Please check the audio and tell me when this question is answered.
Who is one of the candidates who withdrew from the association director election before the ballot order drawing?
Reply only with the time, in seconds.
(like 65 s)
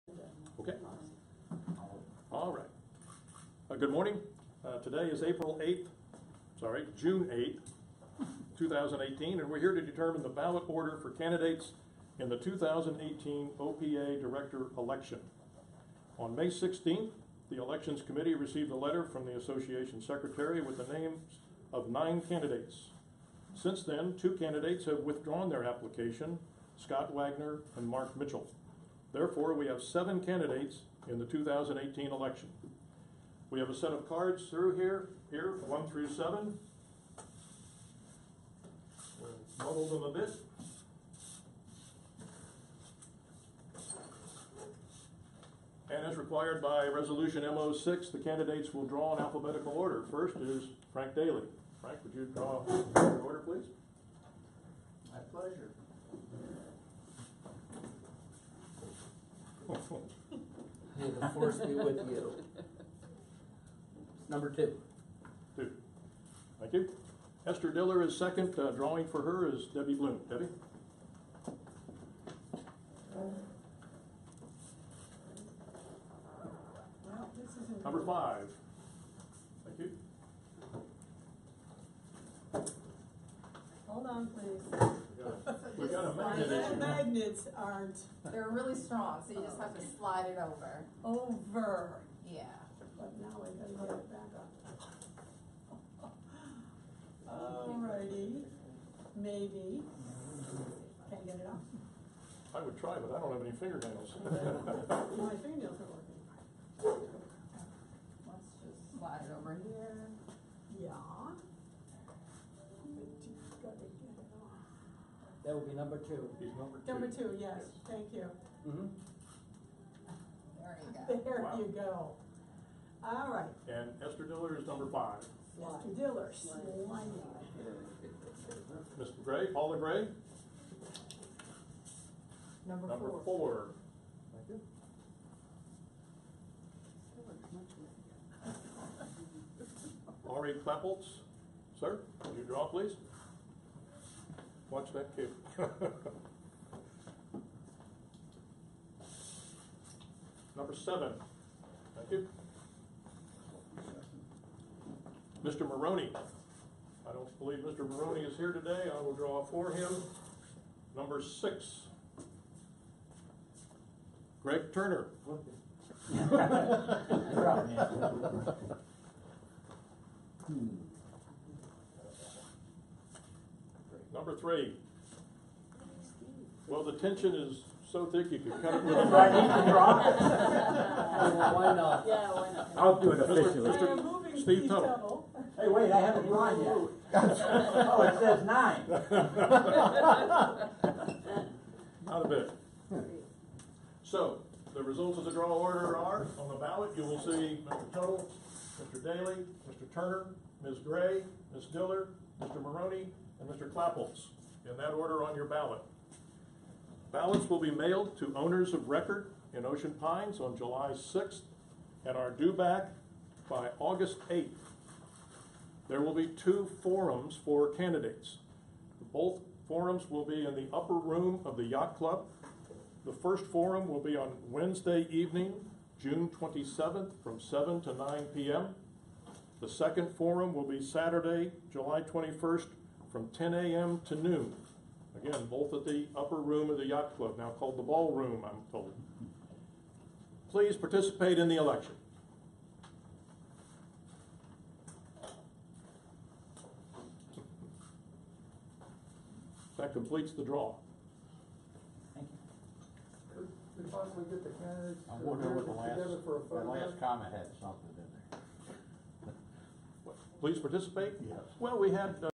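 26 s.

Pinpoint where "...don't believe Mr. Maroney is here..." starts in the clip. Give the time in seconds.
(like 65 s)
157 s.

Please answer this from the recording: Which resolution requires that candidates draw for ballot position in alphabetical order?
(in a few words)
Resolution MO6.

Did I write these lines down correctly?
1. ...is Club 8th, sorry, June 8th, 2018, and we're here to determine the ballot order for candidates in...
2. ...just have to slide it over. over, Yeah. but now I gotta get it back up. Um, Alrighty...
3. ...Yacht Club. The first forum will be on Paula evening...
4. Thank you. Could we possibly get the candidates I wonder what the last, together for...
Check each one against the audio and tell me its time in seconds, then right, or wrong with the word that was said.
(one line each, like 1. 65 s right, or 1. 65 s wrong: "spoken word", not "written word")
1. 5 s wrong: "April", not "Club"
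2. 89 s right
3. 221 s wrong: "Wednesday", not "Paula"
4. 252 s right.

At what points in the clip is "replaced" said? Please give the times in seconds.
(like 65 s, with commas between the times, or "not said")
not said.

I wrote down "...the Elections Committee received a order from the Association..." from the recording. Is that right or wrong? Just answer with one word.
wrong.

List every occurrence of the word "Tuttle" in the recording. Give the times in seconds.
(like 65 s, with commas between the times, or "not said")
184 s, 197 s.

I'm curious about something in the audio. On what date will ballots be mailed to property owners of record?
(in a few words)
July 6th.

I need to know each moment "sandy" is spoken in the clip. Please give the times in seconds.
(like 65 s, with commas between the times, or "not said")
not said.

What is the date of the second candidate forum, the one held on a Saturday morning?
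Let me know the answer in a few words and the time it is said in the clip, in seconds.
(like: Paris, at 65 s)
July 21st, at 231 s.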